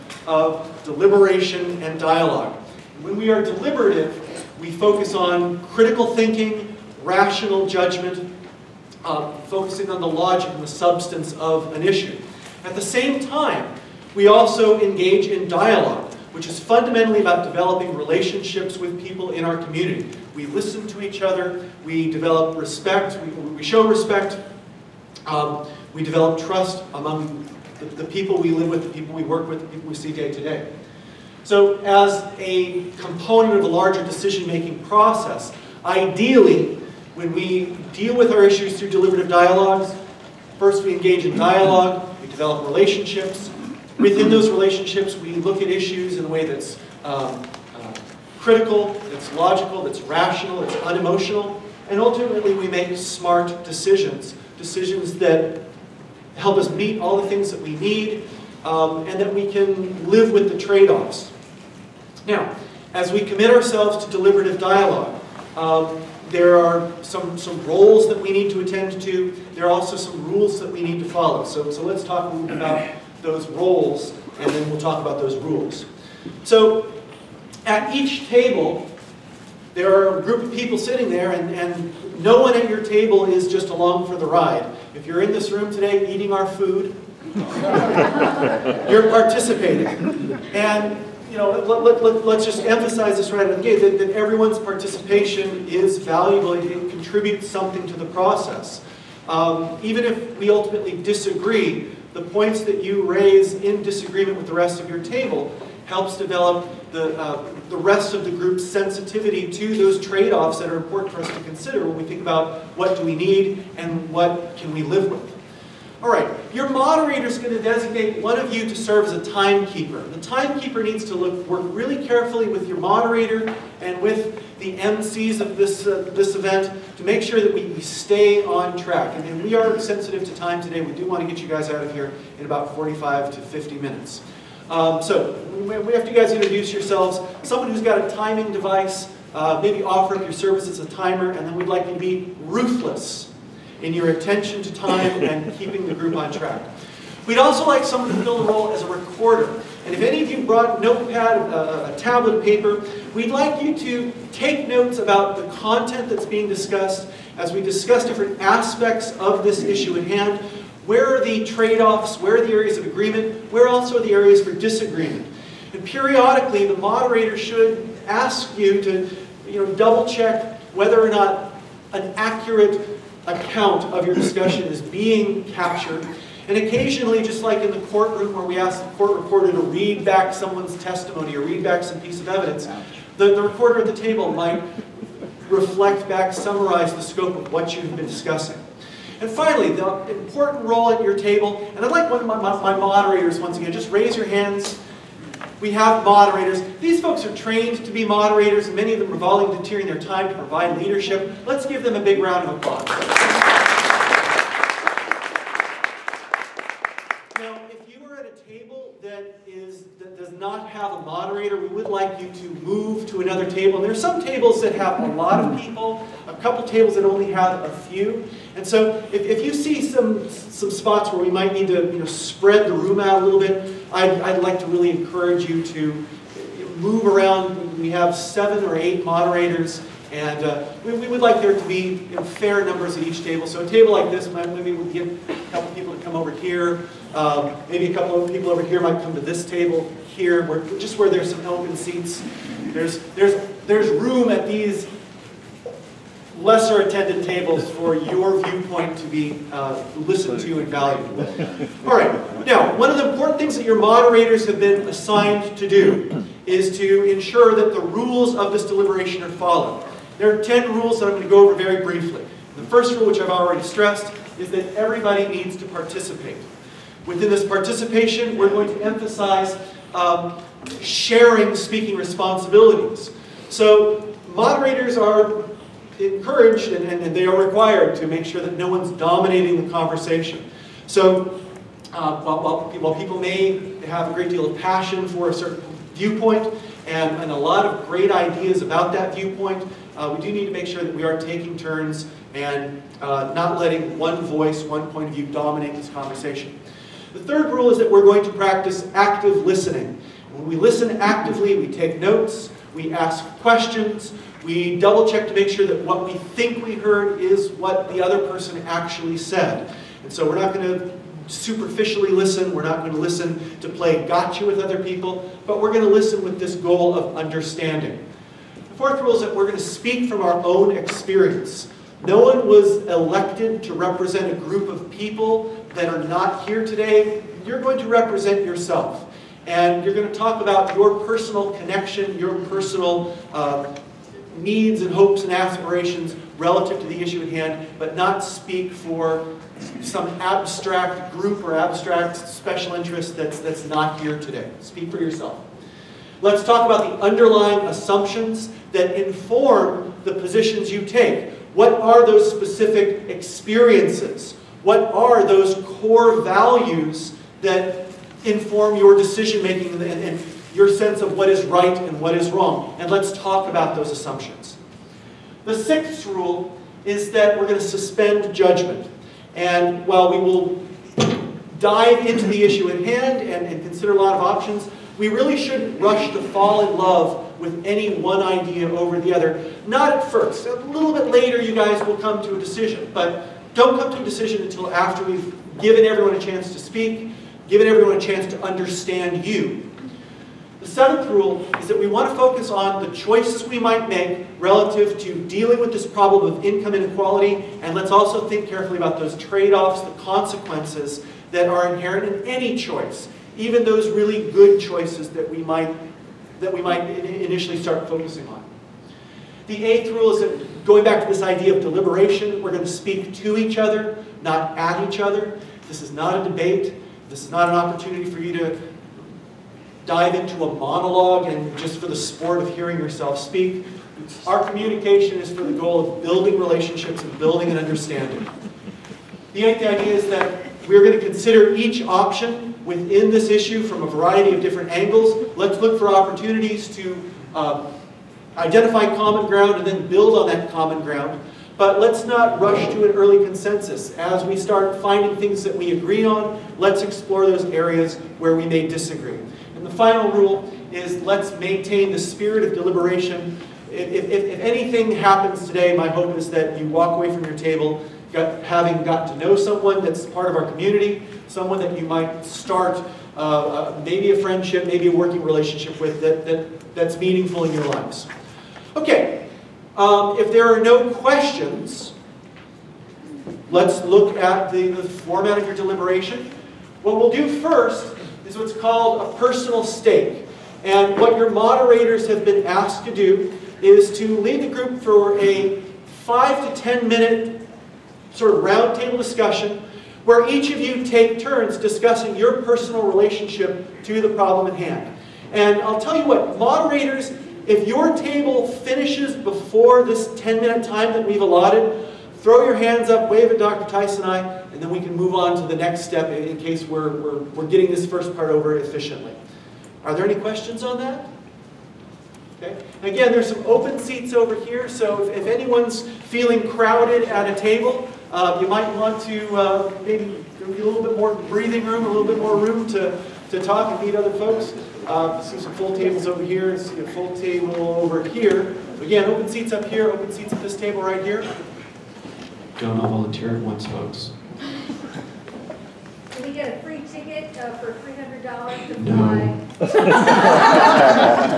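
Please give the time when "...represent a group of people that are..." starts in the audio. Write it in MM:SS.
05:23.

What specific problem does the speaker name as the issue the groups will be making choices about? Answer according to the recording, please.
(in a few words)
income inequality.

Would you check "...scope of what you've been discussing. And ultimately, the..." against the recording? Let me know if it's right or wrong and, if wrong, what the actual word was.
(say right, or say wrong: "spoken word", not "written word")
wrong: "finally", not "ultimately".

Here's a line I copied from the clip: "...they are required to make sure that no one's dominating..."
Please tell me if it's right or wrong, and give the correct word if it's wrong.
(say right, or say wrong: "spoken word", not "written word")
right.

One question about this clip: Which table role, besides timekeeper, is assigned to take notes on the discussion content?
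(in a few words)
recorder.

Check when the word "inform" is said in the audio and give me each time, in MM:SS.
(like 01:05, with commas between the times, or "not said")
05:49, 05:58.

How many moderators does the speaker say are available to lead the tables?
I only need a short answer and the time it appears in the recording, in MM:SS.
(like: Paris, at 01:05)
7 or 8, at 03:48.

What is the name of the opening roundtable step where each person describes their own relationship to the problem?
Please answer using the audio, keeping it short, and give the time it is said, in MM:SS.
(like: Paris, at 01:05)
personal stake, at 07:59.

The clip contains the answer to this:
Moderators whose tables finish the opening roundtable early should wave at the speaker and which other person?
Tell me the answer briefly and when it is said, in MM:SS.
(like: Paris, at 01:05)
Dr. Tyson, at 08:23.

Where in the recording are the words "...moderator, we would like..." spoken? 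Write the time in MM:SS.
03:31.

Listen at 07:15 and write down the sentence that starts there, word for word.
Let's look for opportunities to uh, identify common ground and then build on that common ground.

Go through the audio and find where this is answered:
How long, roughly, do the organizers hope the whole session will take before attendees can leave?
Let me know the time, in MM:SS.
02:12.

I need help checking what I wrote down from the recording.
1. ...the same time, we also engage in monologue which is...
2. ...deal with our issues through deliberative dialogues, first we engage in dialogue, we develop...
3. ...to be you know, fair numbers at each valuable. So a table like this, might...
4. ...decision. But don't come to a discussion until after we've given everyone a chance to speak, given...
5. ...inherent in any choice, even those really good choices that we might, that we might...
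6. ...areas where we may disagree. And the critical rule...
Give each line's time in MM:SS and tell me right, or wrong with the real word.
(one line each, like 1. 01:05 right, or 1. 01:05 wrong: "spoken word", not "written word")
1. 00:12 wrong: "dialogue", not "monologue"
2. 00:37 right
3. 03:51 wrong: "table", not "valuable"
4. 06:22 wrong: "decision", not "discussion"
5. 06:41 right
6. 07:27 wrong: "final", not "critical".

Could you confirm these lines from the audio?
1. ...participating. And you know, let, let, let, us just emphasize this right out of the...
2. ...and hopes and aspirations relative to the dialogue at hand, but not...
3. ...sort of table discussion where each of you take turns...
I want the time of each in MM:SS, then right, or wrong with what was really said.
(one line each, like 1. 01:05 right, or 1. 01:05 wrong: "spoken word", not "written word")
1. 01:29 right
2. 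05:34 wrong: "issue", not "dialogue"
3. 08:08 wrong: "roundtable", not "table".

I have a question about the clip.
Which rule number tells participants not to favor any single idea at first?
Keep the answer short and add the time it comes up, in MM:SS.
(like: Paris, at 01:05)
6, at 06:05.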